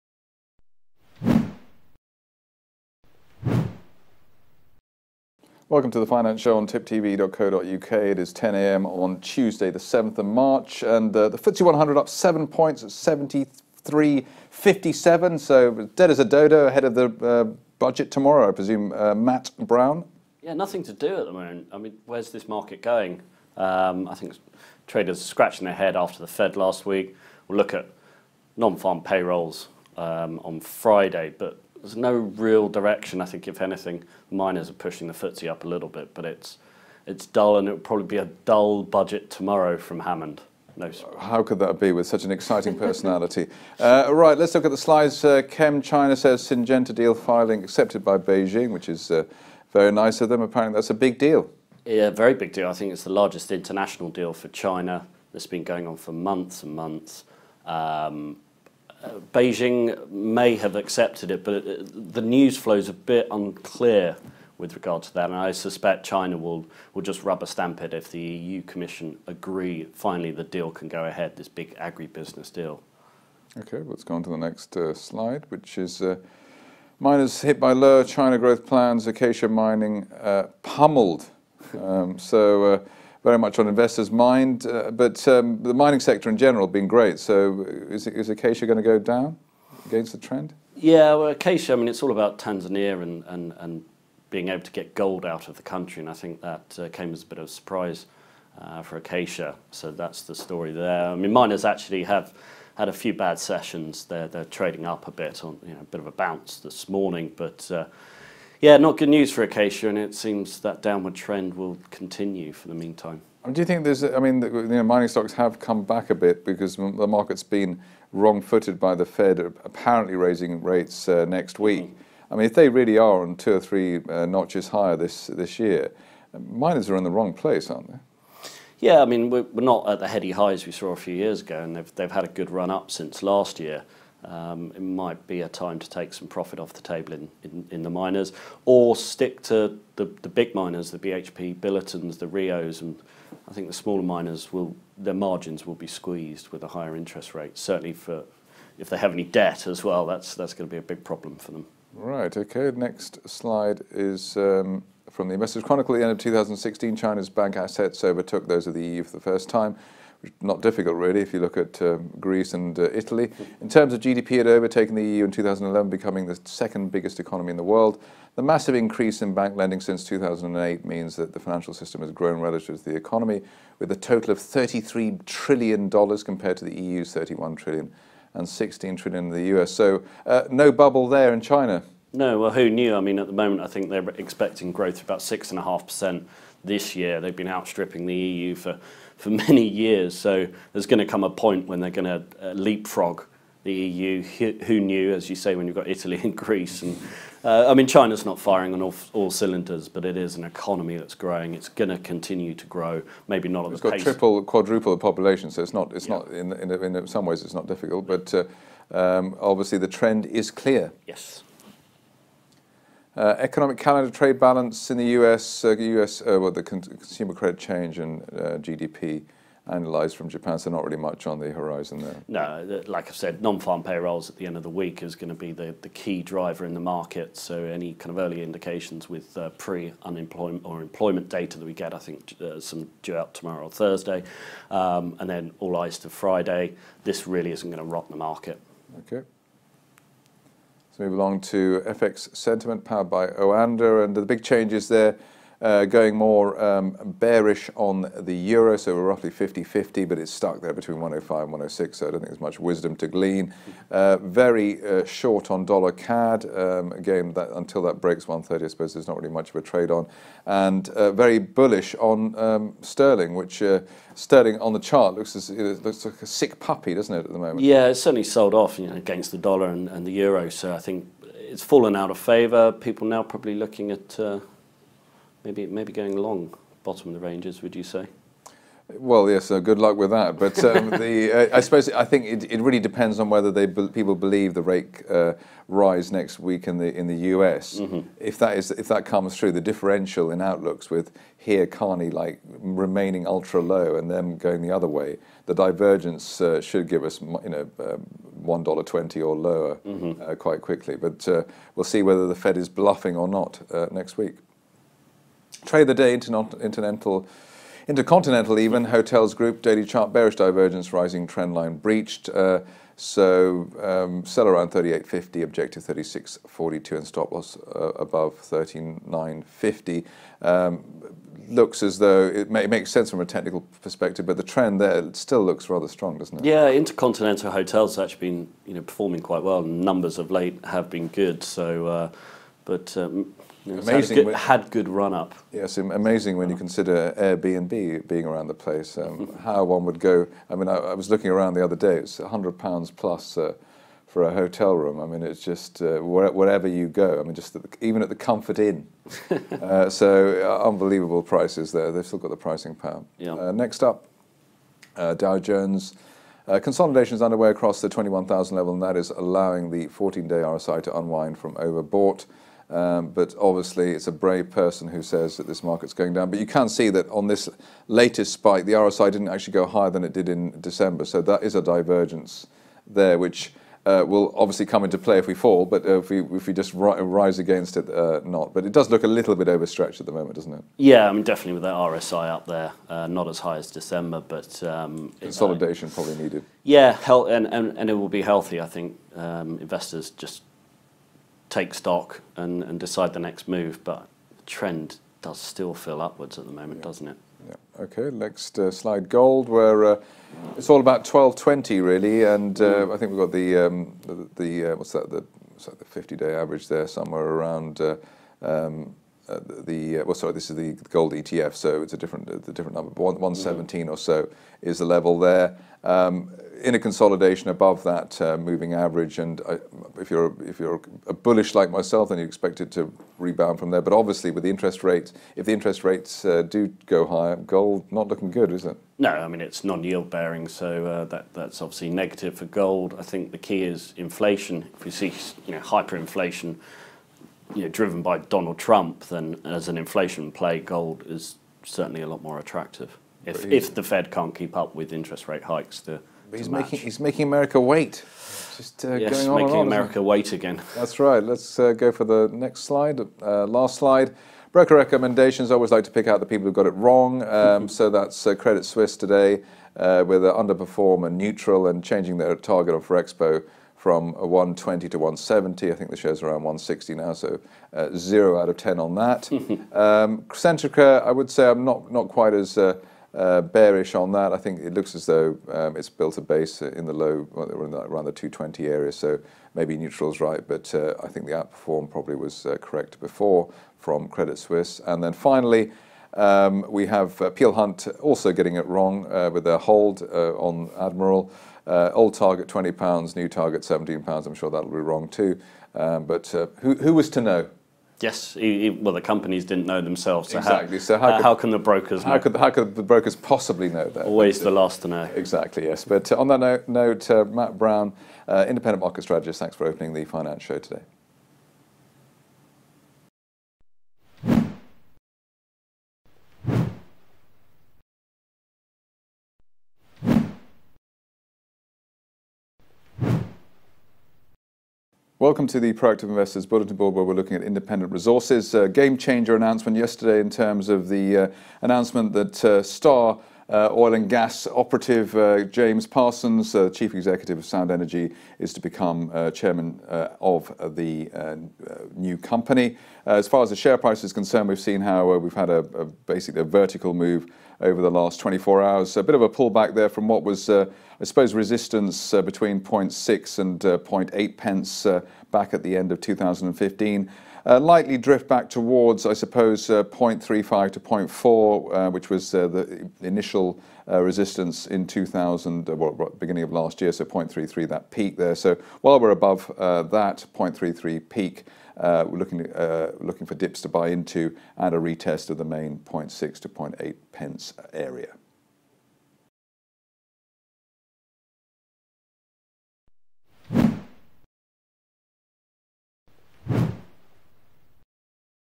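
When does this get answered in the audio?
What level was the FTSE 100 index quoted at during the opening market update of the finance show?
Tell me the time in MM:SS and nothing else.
00:12.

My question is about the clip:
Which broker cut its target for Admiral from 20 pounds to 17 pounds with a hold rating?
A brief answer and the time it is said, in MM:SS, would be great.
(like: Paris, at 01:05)
Peel Hunt, at 08:07.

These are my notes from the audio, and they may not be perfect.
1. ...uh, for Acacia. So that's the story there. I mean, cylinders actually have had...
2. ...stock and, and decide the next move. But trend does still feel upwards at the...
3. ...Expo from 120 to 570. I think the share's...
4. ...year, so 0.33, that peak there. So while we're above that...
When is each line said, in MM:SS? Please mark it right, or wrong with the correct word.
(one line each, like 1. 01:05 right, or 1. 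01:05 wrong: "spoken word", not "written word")
1. 01:38 wrong: "miners", not "cylinders"
2. 06:31 right
3. 07:43 wrong: "170", not "570"
4. 09:26 right.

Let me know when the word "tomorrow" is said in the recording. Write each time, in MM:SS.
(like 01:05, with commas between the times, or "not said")
00:18, 00:39, 03:53.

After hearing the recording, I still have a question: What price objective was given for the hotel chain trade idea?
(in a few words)
36.42.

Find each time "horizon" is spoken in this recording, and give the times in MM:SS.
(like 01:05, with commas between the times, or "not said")
03:41.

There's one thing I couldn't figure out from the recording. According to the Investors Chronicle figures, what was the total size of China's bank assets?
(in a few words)
$33 trillion.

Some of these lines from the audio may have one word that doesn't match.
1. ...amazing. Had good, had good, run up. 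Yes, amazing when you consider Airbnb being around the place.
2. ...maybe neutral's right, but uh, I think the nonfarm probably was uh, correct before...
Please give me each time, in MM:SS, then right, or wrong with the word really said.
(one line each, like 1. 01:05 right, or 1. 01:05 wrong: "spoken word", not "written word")
1. 05:33 right
2. 07:59 wrong: "outperform", not "nonfarm".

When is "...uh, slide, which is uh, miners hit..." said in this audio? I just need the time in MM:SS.
01:14.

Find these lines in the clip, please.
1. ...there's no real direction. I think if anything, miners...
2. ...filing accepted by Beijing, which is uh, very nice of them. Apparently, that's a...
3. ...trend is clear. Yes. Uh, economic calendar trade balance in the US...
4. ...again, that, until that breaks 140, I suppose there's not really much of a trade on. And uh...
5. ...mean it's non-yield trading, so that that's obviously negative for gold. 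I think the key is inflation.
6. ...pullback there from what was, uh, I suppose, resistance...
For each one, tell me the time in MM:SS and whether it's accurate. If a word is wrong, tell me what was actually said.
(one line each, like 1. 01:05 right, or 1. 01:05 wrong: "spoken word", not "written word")
1. 00:31 right
2. 00:47 right
3. 03:29 right
4. 04:16 wrong: "130", not "140"
5. 07:09 wrong: "bearing", not "trading"
6. 09:09 right.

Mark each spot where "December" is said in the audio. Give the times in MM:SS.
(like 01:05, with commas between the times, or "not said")
06:10, 06:23.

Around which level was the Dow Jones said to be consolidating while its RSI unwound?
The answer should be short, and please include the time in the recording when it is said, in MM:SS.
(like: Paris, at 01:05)
21,000, at 05:57.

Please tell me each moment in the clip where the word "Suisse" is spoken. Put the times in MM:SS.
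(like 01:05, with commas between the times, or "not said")
07:38, 08:04.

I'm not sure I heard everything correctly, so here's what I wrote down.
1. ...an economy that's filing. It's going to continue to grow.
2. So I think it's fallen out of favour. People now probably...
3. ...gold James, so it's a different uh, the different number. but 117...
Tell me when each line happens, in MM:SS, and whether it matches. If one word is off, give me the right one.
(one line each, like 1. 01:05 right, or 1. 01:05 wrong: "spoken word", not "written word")
1. 03:20 wrong: "growing", not "filing"
2. 04:30 right
3. 06:50 wrong: "ETF", not "James".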